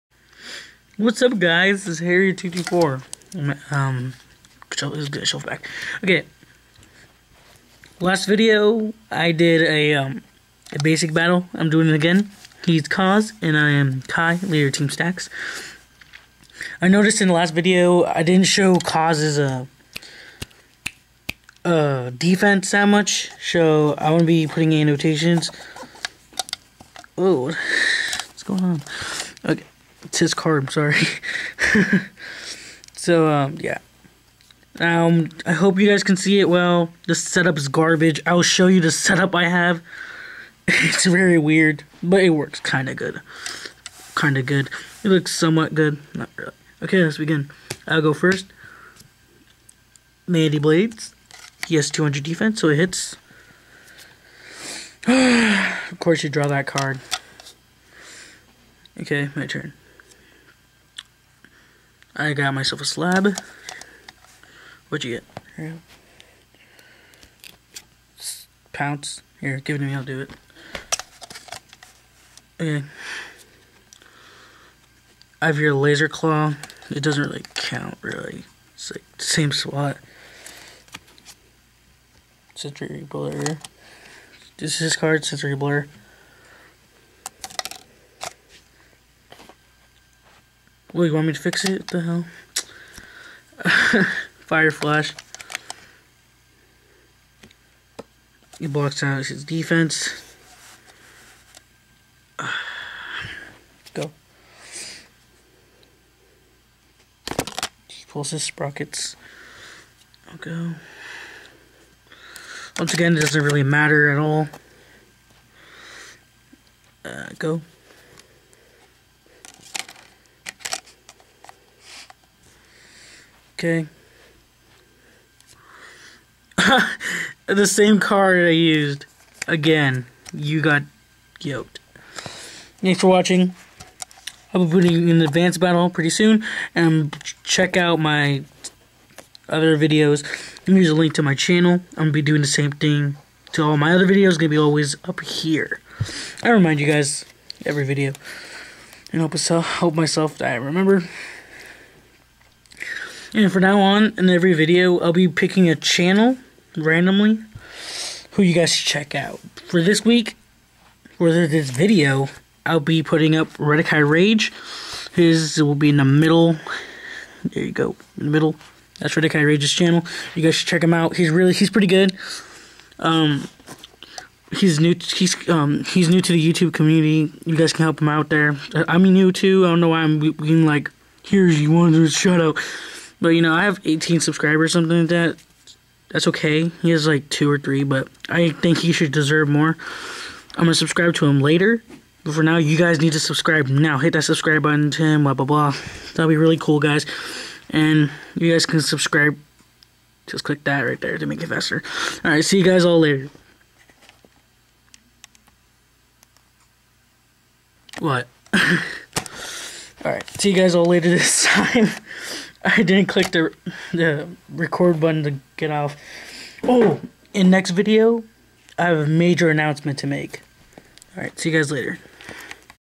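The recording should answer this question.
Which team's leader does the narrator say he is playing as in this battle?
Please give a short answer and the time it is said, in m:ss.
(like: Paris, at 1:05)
Team Stax, at 0:14.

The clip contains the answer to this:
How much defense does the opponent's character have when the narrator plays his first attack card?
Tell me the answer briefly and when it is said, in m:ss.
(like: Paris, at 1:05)
200, at 0:51.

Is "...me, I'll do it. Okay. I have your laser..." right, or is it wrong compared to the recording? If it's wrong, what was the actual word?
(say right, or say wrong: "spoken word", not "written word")
right.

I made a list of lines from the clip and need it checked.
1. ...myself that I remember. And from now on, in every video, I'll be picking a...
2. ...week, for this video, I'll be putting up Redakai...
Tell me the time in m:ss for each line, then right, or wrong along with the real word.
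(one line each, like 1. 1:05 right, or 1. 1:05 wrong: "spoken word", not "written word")
1. 2:29 right
2. 2:40 right.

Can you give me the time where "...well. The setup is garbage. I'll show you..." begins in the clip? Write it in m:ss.
0:36.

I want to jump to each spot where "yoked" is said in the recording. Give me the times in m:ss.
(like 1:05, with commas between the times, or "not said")
2:11.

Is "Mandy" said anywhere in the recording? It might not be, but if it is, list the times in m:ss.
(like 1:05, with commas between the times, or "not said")
0:50.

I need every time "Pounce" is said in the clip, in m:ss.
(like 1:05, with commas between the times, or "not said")
1:08.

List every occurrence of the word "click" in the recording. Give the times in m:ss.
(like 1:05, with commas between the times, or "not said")
3:20, 3:33.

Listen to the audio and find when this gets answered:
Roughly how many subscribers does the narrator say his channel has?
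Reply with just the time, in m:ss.
3:03.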